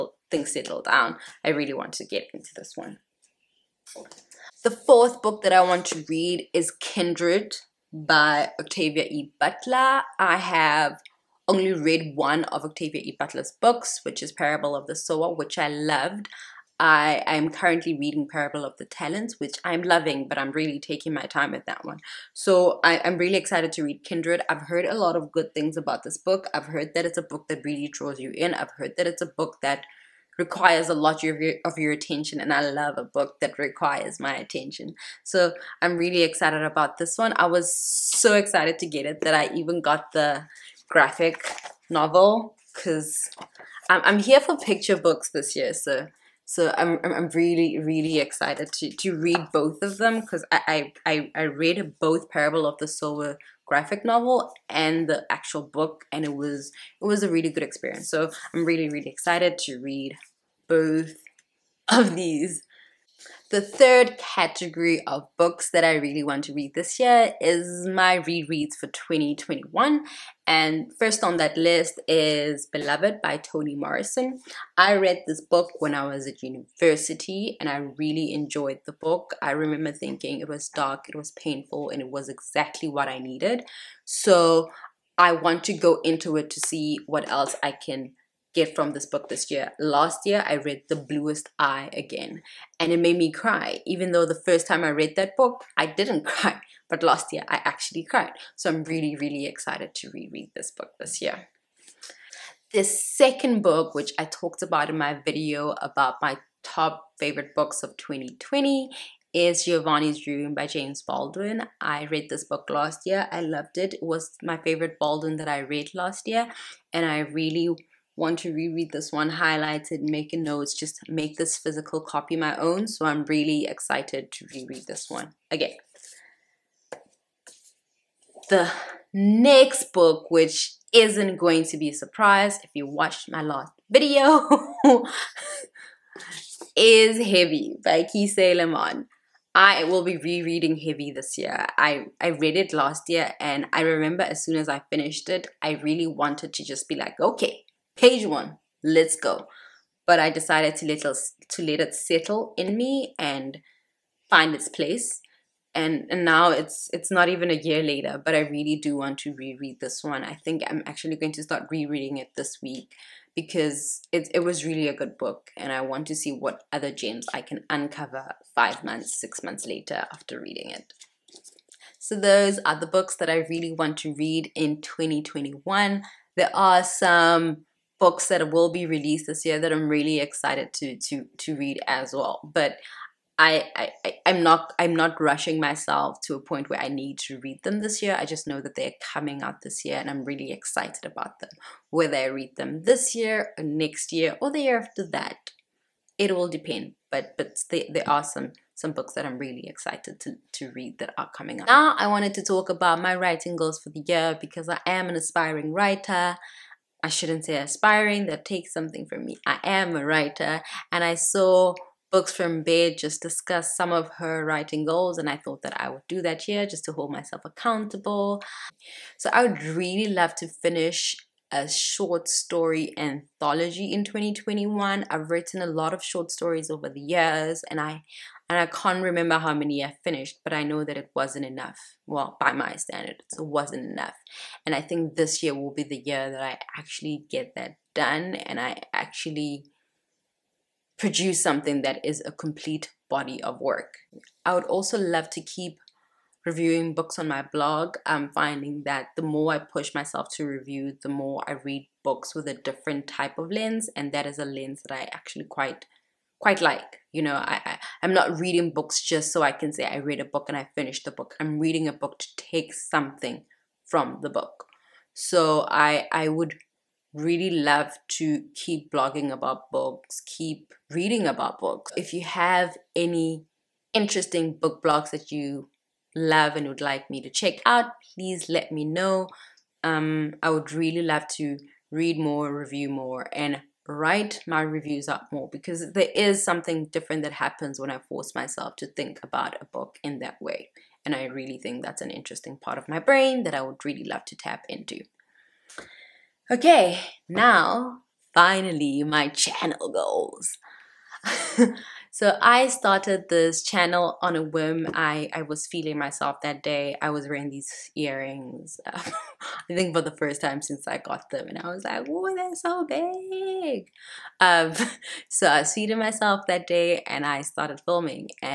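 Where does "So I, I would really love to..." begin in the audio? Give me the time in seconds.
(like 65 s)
265 s.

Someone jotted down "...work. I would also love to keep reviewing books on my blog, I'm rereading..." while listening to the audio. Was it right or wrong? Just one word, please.
wrong.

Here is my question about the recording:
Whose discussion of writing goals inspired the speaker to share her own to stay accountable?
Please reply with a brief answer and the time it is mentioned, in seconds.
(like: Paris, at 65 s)
Books from Bed, at 212 s.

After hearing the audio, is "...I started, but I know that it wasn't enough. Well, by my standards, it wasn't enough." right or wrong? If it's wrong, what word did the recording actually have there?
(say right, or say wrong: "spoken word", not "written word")
wrong: "finished", not "started".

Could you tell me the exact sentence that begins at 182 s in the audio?
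But I, I I'm not I'm not rushing myself to a point where I need to read them this year.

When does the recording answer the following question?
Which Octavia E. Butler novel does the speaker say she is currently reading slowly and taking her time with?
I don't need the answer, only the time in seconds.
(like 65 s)
18 s.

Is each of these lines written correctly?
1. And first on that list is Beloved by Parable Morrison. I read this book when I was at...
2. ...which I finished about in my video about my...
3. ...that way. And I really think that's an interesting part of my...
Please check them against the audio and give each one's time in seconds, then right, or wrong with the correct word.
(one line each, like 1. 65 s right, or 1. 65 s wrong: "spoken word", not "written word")
1. 70 s wrong: "Toni", not "Parable"
2. 103 s wrong: "talked", not "finished"
3. 290 s right.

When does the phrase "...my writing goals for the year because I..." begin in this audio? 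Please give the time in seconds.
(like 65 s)
203 s.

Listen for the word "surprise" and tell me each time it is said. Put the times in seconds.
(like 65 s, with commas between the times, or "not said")
131 s.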